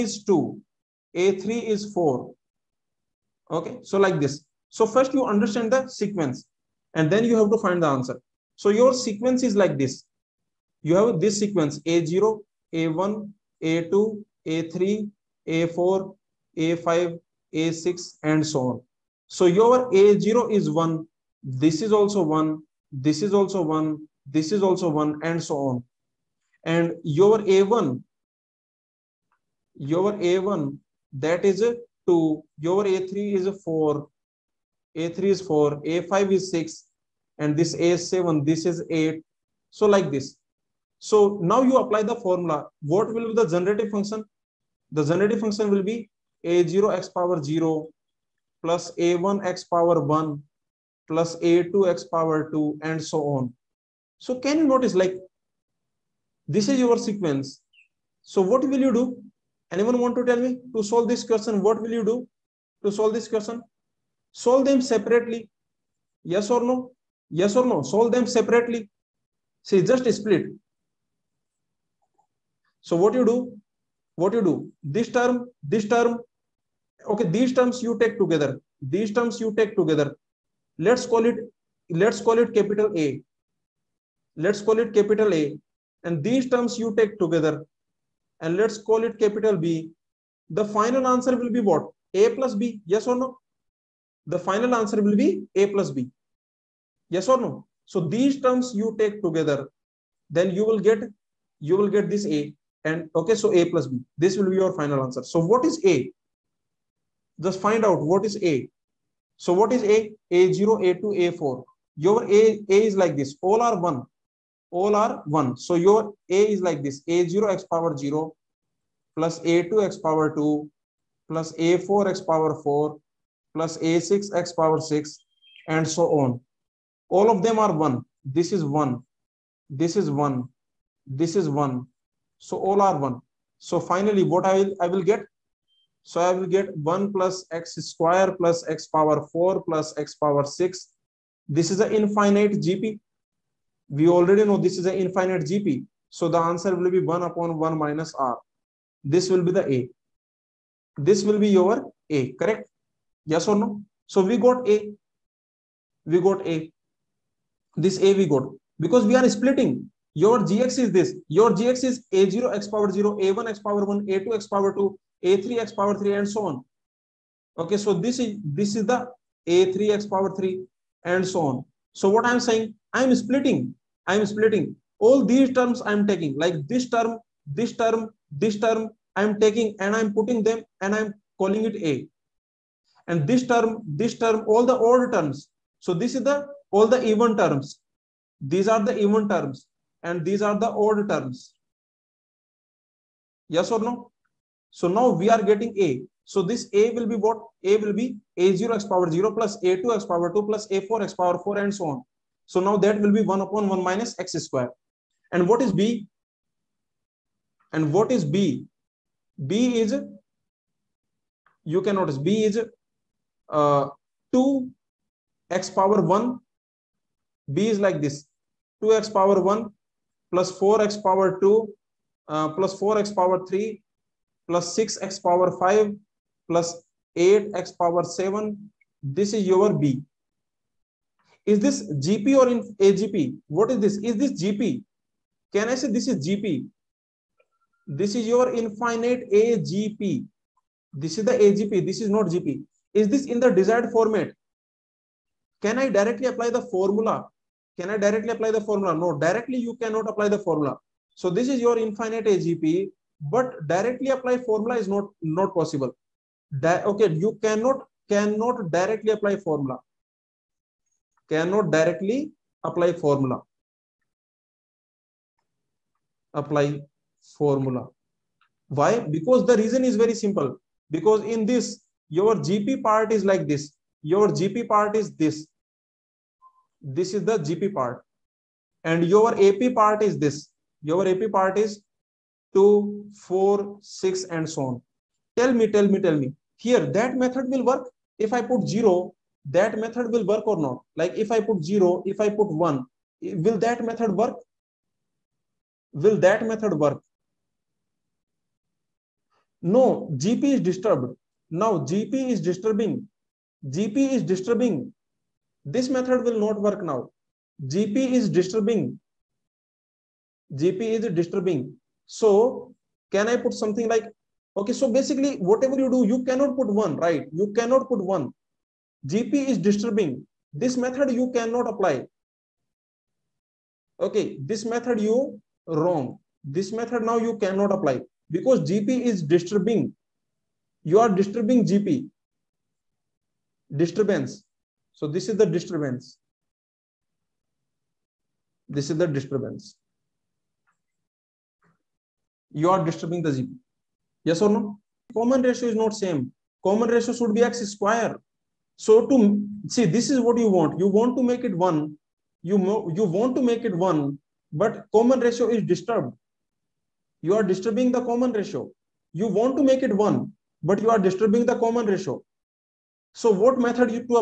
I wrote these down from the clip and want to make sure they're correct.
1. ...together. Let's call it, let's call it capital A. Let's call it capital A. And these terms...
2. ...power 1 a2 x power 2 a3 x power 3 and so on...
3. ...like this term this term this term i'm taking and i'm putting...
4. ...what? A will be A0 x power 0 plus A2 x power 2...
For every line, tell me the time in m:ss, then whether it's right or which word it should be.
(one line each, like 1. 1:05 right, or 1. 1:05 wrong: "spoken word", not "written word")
1. 1:19 right
2. 2:43 right
3. 2:56 right
4. 3:17 right.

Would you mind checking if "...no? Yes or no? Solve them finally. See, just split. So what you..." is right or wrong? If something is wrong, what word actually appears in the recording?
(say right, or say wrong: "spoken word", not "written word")
wrong: "separately", not "finally".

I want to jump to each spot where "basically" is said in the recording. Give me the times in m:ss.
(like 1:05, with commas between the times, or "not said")
5:14.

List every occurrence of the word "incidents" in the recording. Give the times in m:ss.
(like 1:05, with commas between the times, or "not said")
not said.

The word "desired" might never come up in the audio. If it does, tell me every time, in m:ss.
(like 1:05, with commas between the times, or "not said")
4:03.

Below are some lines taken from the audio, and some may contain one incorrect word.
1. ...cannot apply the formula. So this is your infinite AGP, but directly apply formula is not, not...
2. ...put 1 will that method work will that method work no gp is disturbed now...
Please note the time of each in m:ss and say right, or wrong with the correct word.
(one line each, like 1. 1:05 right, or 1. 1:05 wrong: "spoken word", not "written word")
1. 4:09 right
2. 4:52 right.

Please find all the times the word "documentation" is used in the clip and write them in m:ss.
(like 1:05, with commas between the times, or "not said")
not said.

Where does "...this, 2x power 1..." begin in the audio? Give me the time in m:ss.
3:38.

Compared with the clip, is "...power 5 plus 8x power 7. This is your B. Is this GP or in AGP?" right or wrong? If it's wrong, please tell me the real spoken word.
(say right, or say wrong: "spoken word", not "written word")
right.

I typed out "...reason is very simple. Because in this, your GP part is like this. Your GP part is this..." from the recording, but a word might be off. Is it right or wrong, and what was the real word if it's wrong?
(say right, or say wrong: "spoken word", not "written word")
right.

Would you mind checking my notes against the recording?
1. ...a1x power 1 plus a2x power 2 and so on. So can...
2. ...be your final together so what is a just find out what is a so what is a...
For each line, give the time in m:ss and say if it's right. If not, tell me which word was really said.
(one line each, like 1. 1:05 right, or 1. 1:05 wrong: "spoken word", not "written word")
1. 0:48 right
2. 1:44 wrong: "answer", not "together".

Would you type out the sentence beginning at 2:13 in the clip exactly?
So finally, what I will, I will get?